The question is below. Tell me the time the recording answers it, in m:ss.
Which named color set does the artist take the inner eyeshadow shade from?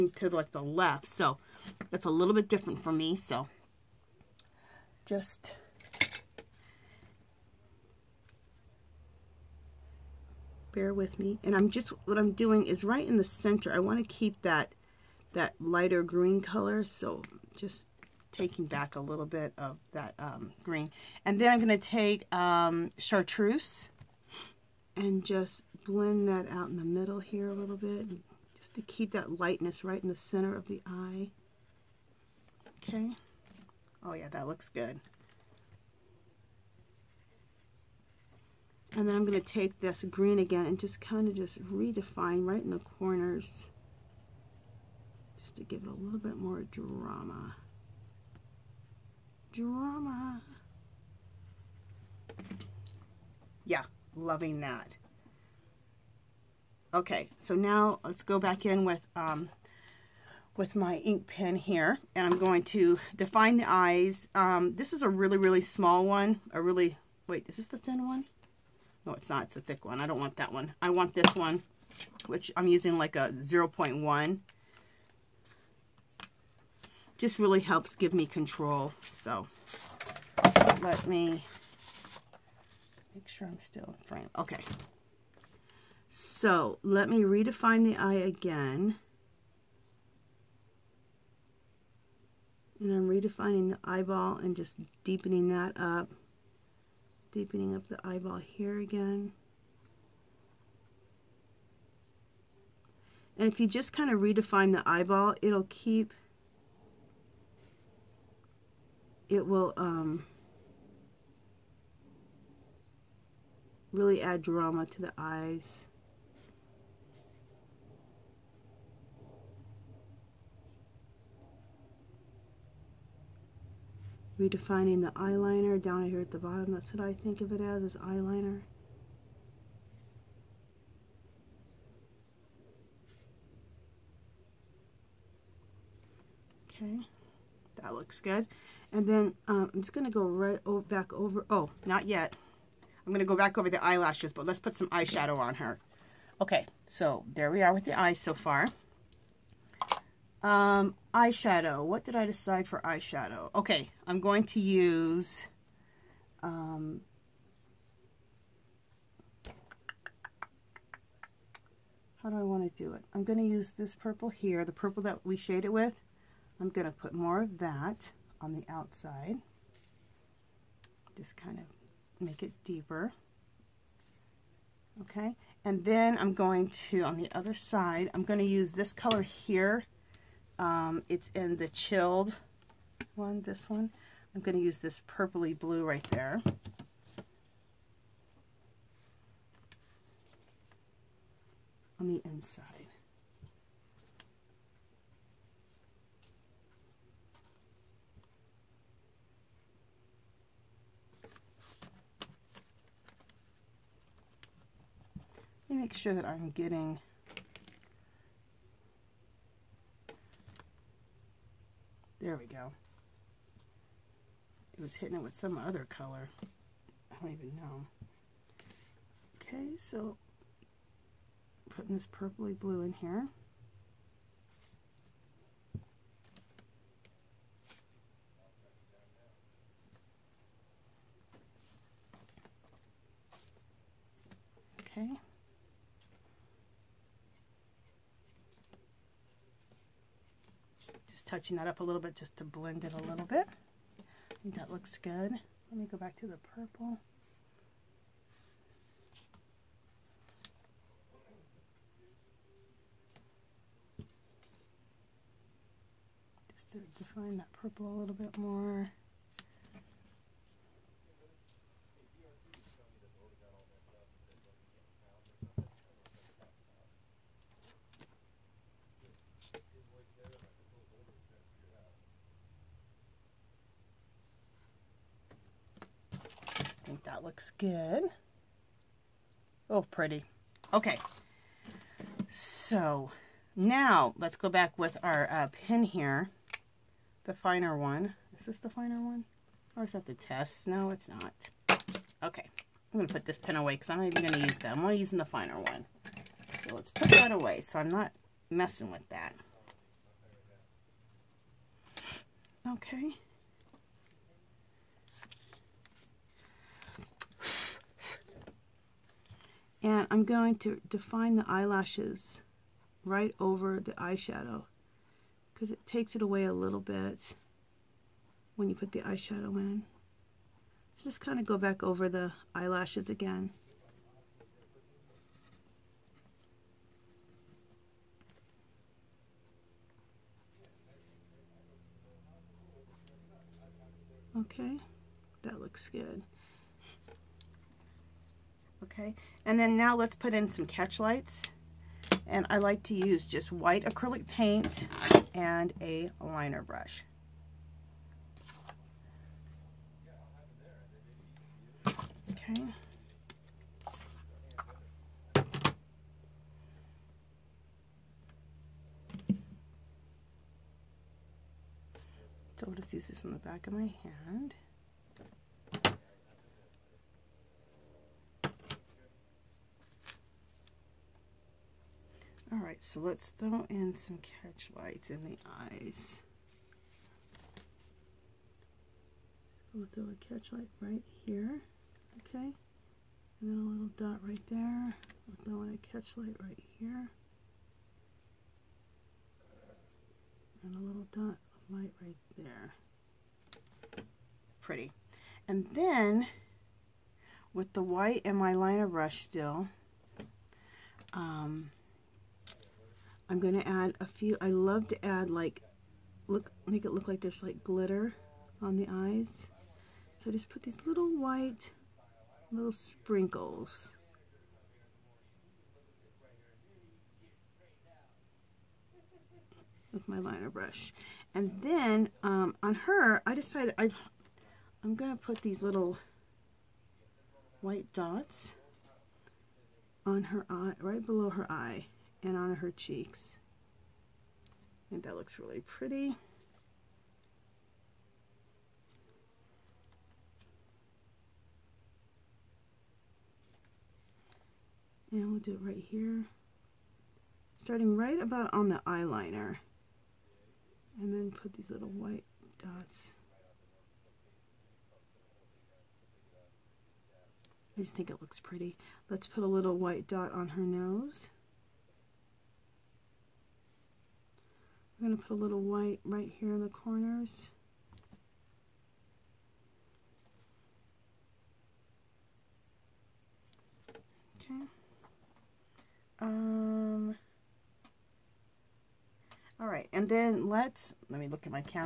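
3:01.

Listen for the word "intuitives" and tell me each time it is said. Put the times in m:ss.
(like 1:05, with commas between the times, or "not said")
not said.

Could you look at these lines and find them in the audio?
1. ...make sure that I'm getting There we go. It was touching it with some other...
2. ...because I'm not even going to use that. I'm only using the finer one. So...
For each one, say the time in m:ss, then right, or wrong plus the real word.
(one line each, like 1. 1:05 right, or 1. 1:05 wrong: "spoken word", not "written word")
1. 3:25 wrong: "hitting", not "touching"
2. 4:53 right.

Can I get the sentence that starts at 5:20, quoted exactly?
So just kind of go back over the eyelashes again.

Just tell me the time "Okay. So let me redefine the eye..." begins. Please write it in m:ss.
1:24.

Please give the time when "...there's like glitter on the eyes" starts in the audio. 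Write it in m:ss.
6:47.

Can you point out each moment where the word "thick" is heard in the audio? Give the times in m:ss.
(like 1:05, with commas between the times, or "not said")
1:09.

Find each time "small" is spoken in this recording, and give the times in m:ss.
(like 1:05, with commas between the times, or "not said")
1:05.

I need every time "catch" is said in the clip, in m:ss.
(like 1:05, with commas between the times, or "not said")
5:40, 6:14, 6:20, 6:25.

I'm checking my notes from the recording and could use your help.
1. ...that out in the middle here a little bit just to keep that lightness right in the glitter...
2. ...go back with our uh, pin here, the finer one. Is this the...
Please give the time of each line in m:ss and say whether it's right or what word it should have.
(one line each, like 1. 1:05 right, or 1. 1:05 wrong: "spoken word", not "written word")
1. 0:26 wrong: "center", not "glitter"
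2. 4:44 right.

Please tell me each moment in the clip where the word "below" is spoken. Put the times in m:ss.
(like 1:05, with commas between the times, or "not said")
7:11.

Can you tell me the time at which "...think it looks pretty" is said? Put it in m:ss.
7:37.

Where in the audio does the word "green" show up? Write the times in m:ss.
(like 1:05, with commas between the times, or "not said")
0:16, 0:20, 0:40.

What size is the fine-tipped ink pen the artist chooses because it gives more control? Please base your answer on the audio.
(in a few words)
0.1.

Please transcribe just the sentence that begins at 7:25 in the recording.
And we'll do it right here.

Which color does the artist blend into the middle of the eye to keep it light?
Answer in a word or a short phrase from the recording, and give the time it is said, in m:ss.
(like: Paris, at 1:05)
chartreuse, at 0:22.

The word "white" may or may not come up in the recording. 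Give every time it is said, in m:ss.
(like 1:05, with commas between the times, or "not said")
5:43, 6:37, 6:51, 7:07, 7:31, 7:39, 7:45.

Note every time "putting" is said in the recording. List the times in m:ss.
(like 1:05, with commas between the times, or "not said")
3:41.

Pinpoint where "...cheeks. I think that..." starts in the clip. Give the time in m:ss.
7:12.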